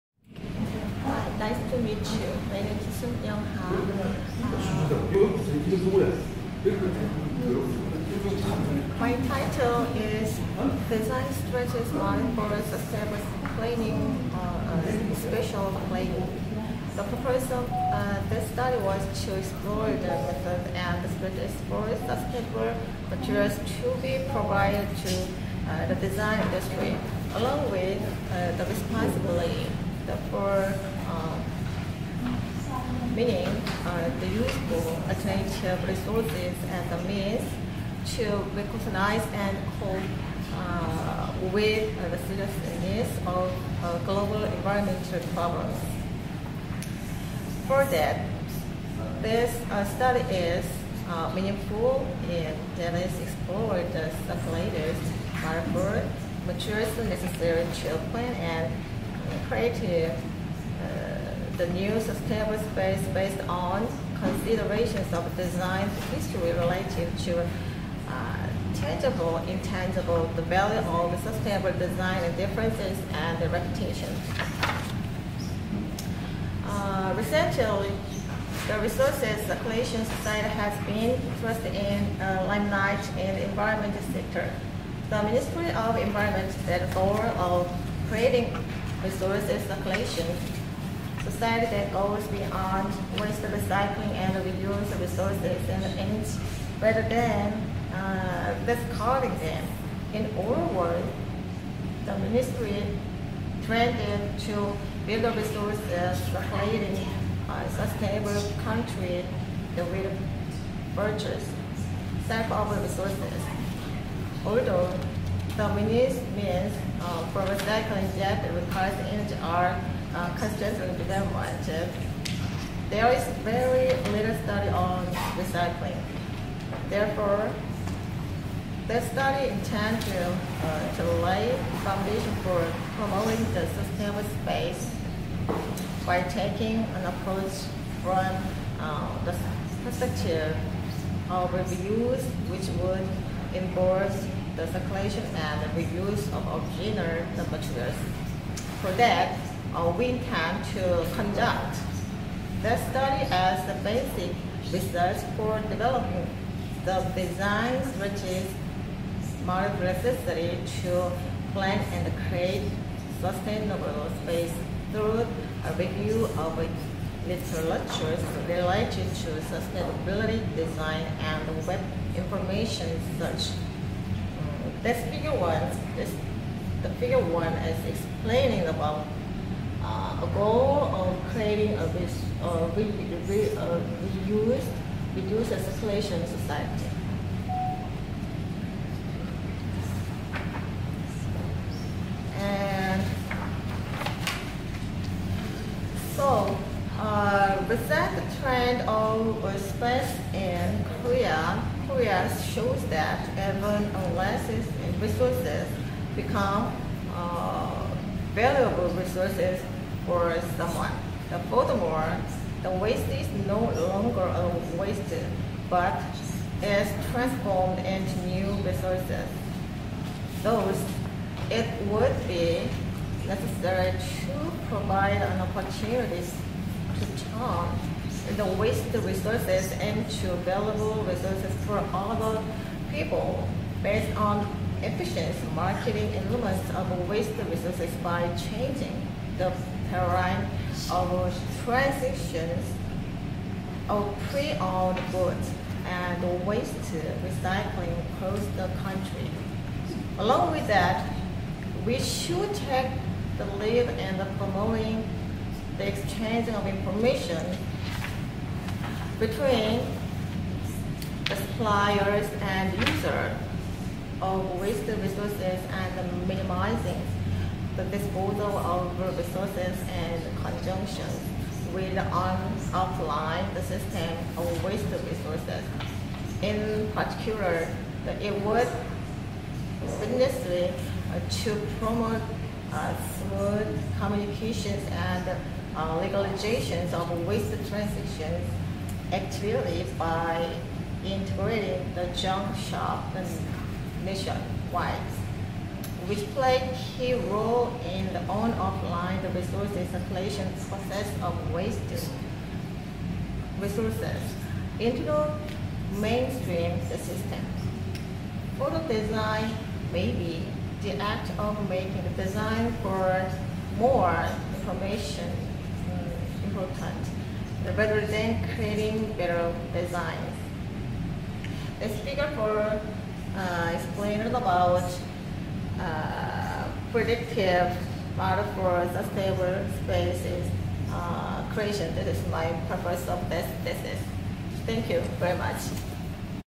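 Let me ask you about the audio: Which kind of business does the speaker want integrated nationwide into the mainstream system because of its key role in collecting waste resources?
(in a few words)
junk shop.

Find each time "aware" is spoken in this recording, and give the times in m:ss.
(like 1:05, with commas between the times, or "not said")
1:52.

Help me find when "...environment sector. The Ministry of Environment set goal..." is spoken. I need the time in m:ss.
1:23.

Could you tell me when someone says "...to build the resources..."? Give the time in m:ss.
1:44.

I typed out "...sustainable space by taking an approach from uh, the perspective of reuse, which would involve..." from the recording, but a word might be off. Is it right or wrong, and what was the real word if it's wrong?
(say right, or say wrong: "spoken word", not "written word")
right.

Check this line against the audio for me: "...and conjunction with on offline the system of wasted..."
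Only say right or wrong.
right.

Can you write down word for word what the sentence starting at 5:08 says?
Photo design may be the act of making the design for more information mm, important rather than creating better designs.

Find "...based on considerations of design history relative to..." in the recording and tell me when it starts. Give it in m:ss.
1:03.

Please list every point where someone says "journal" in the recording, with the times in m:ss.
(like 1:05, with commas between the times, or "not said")
not said.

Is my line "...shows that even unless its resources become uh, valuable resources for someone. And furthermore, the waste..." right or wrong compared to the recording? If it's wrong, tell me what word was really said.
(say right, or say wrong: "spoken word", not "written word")
right.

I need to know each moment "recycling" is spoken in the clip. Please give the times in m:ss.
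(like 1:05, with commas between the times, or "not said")
1:33, 1:57, 2:05, 4:07.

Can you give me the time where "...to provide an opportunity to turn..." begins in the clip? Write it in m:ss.
3:43.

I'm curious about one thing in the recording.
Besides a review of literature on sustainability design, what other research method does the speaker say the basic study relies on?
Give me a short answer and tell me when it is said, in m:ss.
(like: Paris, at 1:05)
web information search, at 2:51.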